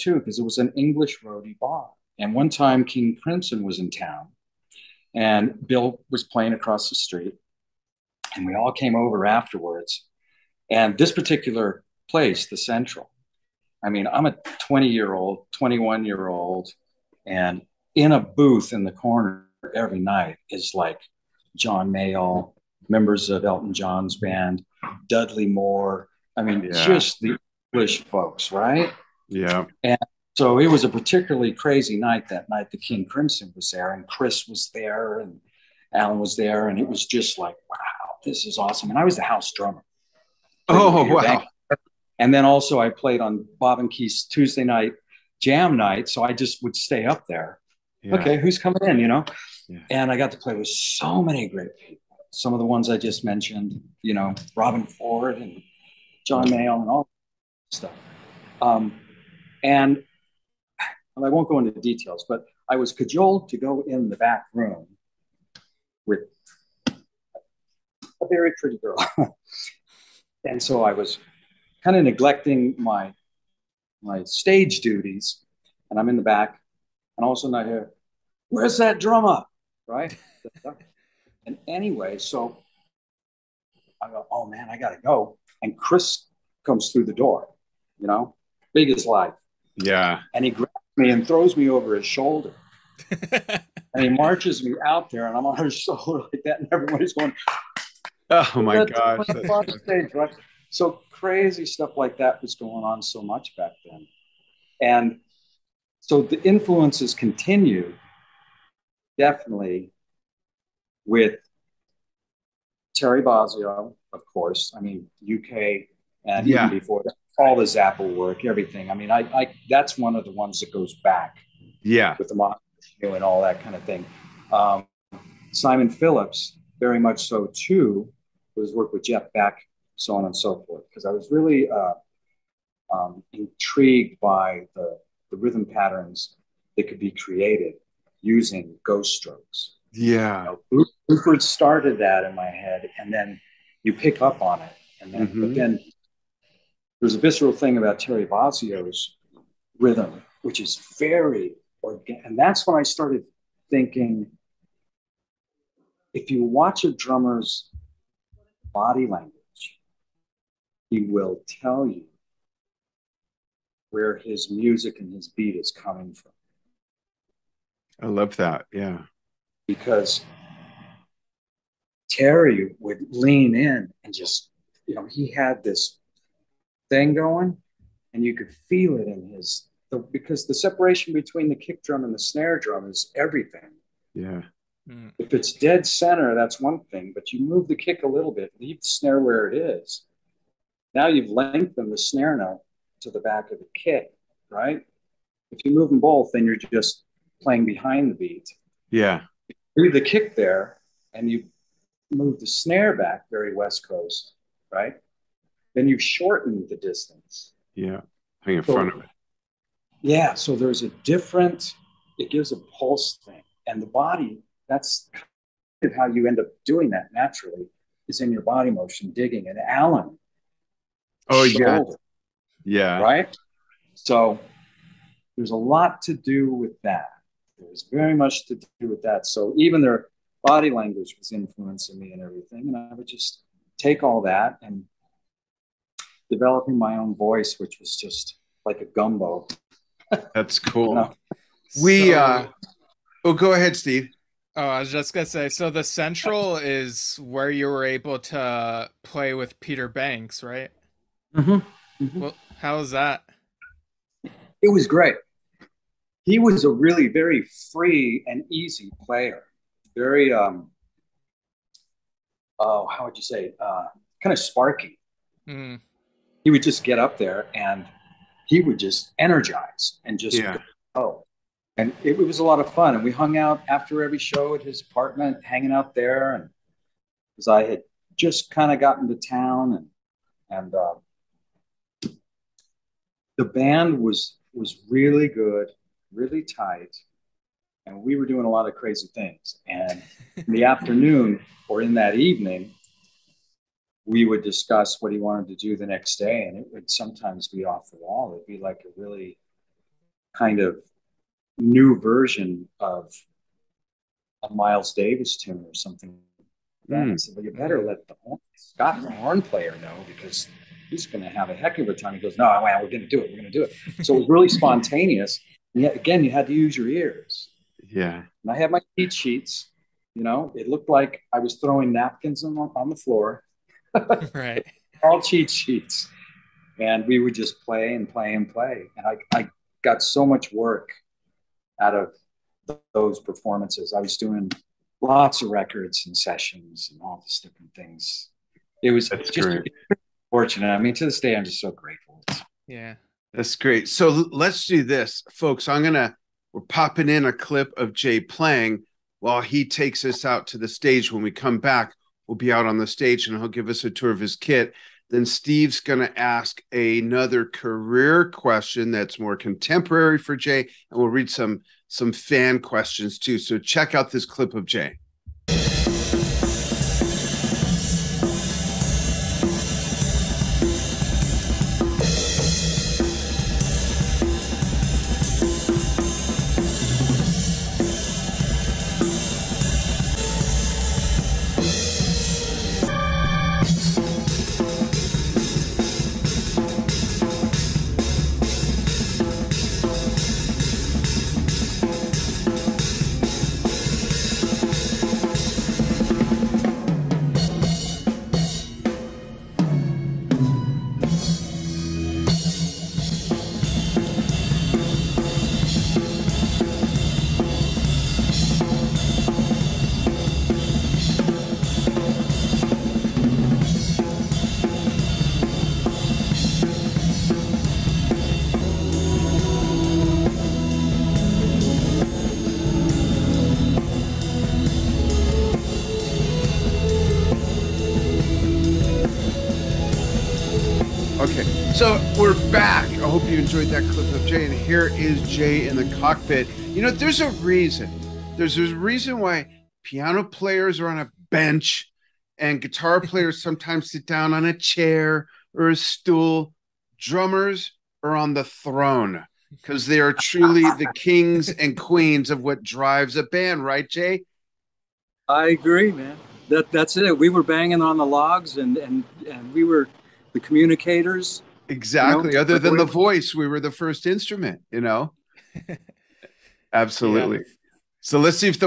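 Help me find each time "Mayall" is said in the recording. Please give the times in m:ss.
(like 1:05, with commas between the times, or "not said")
0:21, 0:56.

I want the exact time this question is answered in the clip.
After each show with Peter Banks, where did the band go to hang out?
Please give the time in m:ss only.
4:34.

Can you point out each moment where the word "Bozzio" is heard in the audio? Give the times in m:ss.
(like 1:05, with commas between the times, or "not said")
1:53, 2:28.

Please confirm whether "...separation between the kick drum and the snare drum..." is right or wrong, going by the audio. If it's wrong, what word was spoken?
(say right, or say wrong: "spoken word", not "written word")
right.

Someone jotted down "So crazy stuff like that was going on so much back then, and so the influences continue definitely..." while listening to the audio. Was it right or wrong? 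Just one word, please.
right.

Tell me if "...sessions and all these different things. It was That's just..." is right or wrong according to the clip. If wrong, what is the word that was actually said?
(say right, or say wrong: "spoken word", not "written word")
right.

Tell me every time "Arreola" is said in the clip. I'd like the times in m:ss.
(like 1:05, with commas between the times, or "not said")
not said.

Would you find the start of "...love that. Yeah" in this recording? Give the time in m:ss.
2:48.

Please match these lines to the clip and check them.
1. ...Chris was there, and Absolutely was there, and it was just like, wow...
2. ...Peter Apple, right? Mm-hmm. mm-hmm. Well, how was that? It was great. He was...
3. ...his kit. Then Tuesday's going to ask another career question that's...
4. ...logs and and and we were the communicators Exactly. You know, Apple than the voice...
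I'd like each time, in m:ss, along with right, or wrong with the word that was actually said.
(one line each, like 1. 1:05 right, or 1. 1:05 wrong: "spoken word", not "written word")
1. 0:34 wrong: "Alan", not "Absolutely"
2. 4:09 wrong: "Banks", not "Apple"
3. 5:54 wrong: "Steve", not "Tuesday"
4. 7:38 wrong: "Other", not "Apple".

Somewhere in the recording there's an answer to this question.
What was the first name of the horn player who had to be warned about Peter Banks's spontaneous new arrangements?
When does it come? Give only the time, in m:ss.
5:08.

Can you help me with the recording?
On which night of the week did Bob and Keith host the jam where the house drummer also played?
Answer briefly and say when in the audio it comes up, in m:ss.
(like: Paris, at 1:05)
Tuesday, at 0:44.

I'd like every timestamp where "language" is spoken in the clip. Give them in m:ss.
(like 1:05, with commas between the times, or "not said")
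2:39, 3:50.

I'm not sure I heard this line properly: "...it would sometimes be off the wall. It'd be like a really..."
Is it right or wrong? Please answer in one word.
right.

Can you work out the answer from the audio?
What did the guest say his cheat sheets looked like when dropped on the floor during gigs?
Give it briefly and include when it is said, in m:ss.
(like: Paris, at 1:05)
Napkins, at 5:21.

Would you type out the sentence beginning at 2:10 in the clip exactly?
Because I was really uh, um, intrigued by the, the rhythm patterns that could be created using ghost strokes.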